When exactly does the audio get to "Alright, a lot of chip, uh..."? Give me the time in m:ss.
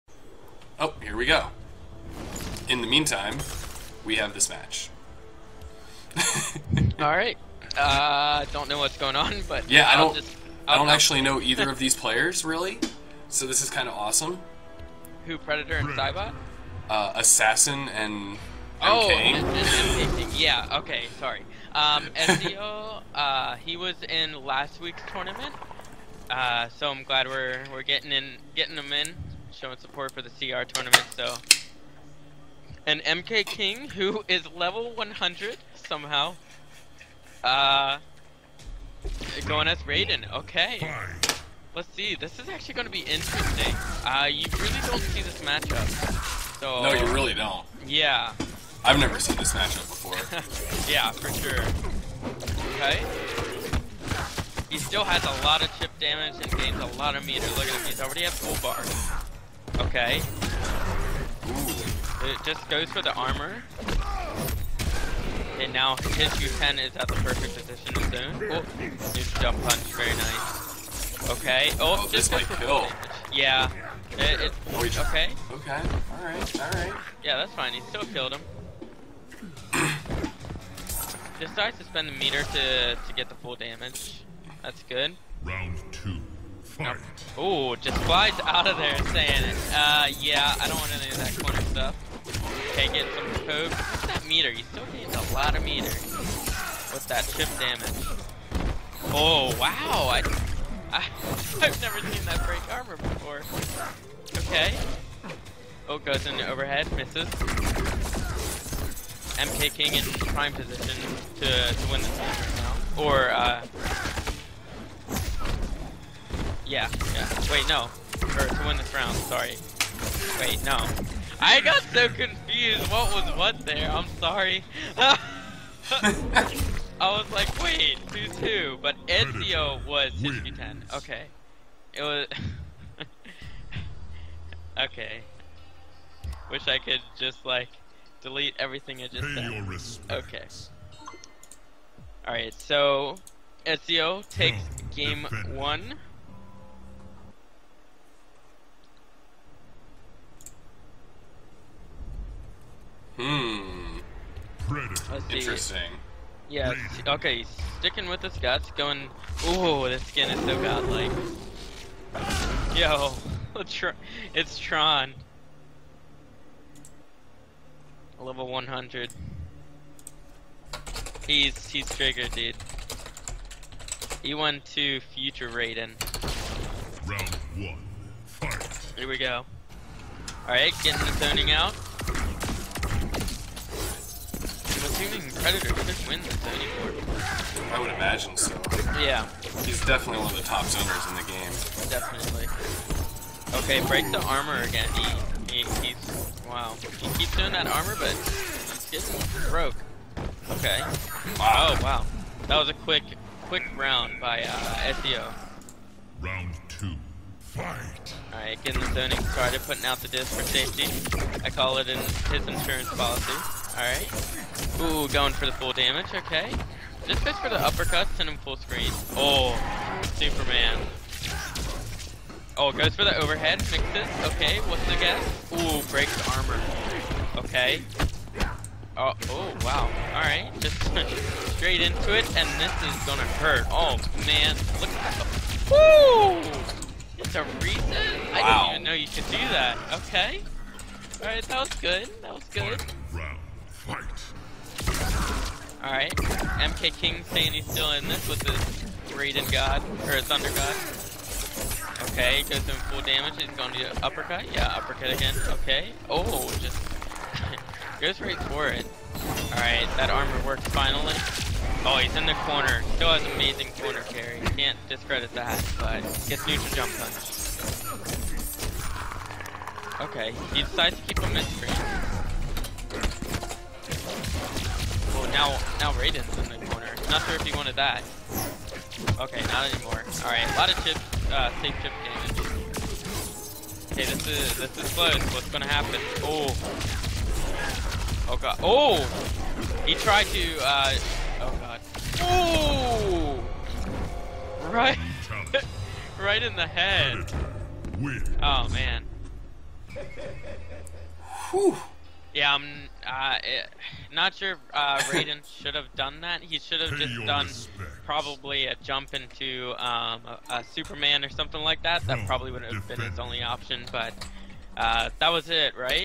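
4:40.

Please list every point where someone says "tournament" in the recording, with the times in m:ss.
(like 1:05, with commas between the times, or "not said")
0:25, 0:30.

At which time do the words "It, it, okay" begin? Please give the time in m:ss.
1:14.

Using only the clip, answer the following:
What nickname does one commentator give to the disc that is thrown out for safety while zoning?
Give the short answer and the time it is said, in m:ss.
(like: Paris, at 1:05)
insurance policy, at 3:32.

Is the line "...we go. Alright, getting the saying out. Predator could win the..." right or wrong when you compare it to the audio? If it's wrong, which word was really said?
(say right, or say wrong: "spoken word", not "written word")
wrong: "zoning", not "saying".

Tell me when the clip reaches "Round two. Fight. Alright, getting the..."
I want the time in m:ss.
3:26.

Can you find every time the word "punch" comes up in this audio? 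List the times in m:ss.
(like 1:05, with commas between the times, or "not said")
1:09, 4:26.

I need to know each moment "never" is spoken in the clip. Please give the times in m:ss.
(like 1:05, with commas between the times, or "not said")
0:48, 1:41.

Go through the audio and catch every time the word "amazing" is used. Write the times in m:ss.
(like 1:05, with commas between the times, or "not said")
4:23.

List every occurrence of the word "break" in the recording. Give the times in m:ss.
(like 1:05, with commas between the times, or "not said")
1:42, 3:13, 3:45.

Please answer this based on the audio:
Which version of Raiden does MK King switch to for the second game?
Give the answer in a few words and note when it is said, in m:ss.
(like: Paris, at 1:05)
Future Raiden, at 2:54.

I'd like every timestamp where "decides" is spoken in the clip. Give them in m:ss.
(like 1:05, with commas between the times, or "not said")
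1:21, 4:30.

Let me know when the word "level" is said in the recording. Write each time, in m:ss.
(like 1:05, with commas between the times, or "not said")
0:34, 2:48.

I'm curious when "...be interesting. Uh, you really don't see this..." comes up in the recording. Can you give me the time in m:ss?
0:42.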